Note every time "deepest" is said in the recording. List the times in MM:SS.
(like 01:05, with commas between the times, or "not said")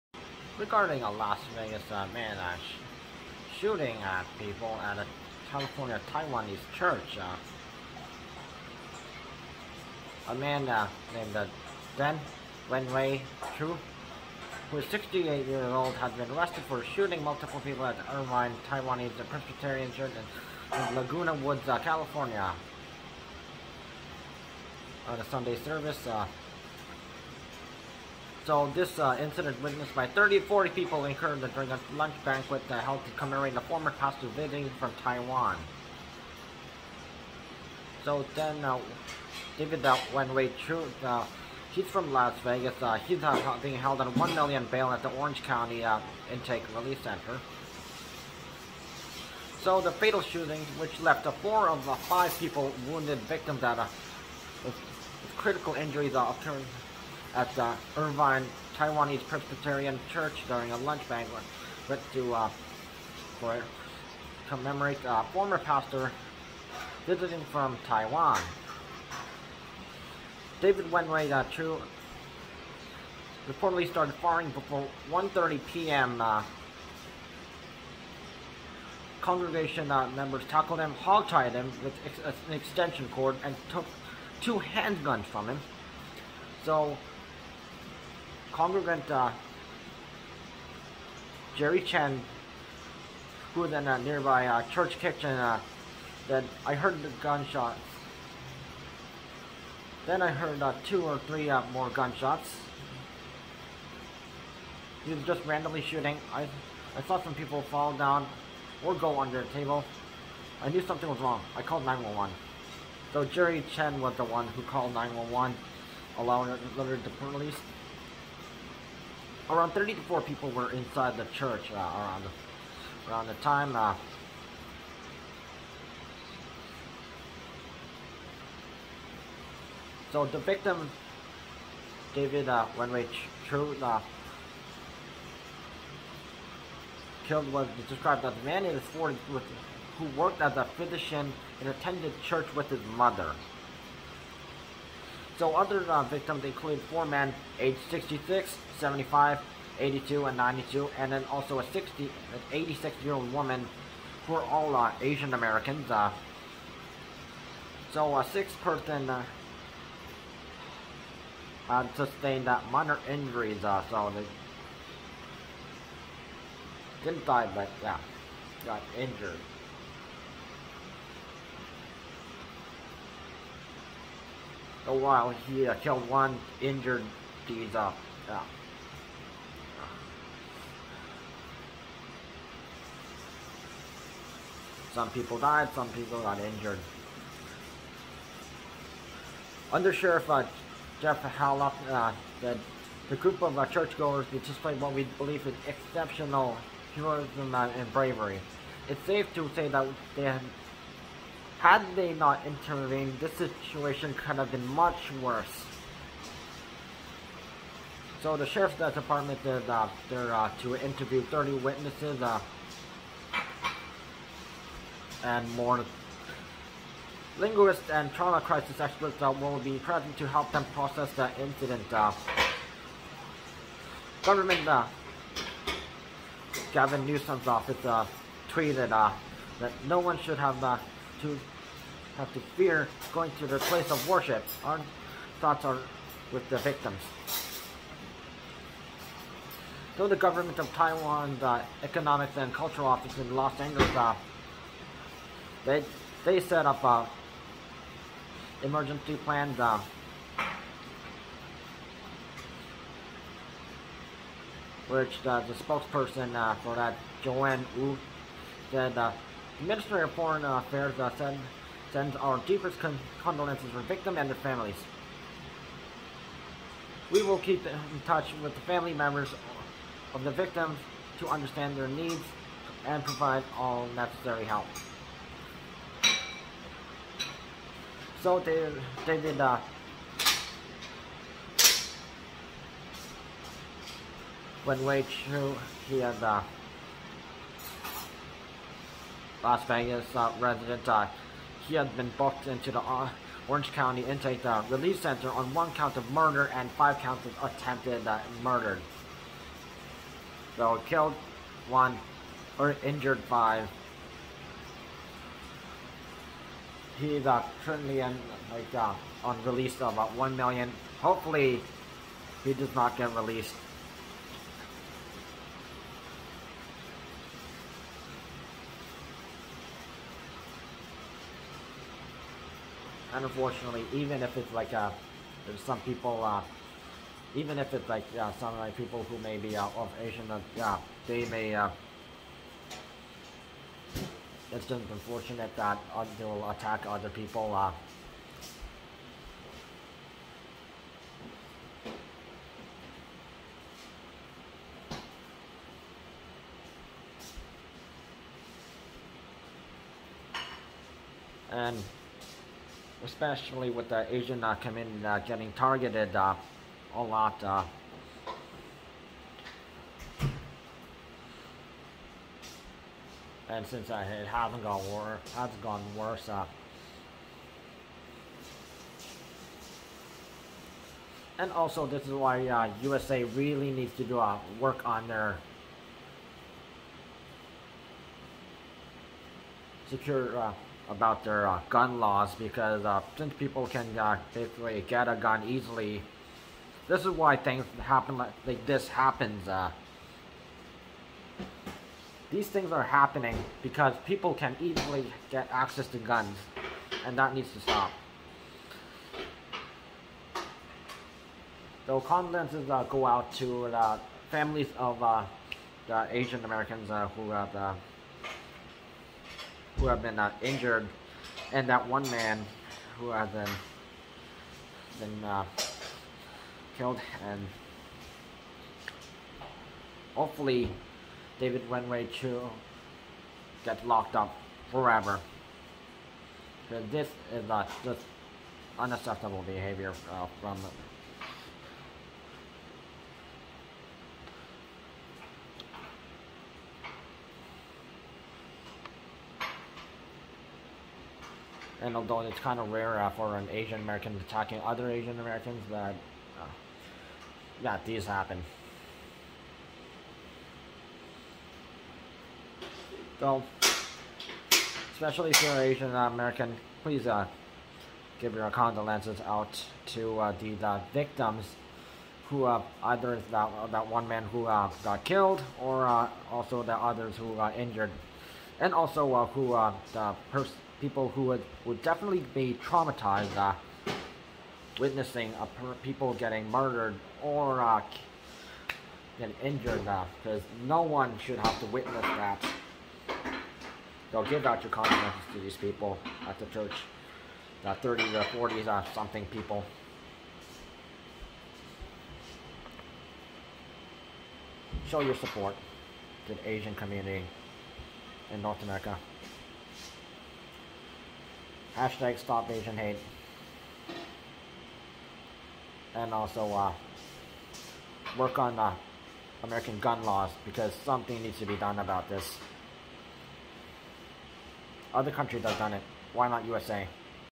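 04:22.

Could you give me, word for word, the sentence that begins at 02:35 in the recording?
Uh, so a sixth person uh, um, sustained uh, minor injuries, uh, so they didn't die, but yeah, got injured.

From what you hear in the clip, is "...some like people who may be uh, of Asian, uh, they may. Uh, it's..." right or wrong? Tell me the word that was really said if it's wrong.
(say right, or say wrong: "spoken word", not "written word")
right.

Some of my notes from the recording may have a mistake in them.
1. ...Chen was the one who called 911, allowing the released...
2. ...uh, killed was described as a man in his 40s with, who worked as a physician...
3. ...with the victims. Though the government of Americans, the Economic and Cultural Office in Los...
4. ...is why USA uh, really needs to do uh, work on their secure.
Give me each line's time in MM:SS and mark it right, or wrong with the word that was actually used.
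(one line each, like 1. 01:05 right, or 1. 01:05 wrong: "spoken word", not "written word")
1. 01:53 right
2. 02:13 right
3. 03:56 wrong: "Taiwan", not "Americans"
4. 06:12 right.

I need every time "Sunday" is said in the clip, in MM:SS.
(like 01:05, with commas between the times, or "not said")
00:25.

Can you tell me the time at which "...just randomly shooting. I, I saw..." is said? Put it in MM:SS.
01:45.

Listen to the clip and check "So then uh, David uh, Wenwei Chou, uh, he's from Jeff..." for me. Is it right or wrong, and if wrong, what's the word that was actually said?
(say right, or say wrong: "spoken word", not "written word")
wrong: "Las", not "Jeff".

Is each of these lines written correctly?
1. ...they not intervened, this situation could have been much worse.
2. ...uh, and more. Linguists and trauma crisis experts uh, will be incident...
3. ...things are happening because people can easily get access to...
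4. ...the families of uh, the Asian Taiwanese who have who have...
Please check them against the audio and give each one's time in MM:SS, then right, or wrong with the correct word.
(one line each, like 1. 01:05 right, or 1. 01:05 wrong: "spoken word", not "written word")
1. 03:21 right
2. 03:32 wrong: "present", not "incident"
3. 06:32 right
4. 06:43 wrong: "Americans", not "Taiwanese".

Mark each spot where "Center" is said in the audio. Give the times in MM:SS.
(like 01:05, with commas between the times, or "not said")
00:47, 04:55.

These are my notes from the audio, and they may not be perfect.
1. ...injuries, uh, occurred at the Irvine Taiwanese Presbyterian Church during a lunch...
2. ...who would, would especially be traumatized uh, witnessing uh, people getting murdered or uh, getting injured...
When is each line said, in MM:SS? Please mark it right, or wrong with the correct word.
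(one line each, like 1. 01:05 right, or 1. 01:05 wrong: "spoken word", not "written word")
1. 00:55 right
2. 07:51 wrong: "definitely", not "especially".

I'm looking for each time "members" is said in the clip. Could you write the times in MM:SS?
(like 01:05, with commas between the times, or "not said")
01:20, 04:28.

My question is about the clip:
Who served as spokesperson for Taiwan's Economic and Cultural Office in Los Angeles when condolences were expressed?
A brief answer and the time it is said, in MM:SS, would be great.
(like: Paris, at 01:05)
Joanne Wu, at 04:17.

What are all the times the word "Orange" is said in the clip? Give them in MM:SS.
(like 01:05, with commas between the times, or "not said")
00:45, 04:53.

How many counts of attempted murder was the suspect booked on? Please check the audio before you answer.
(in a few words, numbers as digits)
5.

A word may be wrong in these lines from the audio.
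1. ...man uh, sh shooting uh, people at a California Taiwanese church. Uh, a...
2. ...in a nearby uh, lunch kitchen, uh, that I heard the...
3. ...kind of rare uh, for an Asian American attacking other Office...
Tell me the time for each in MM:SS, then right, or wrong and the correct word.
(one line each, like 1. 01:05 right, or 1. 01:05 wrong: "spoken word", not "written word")
1. 00:02 right
2. 01:33 wrong: "church", not "lunch"
3. 07:22 wrong: "Asian", not "Office".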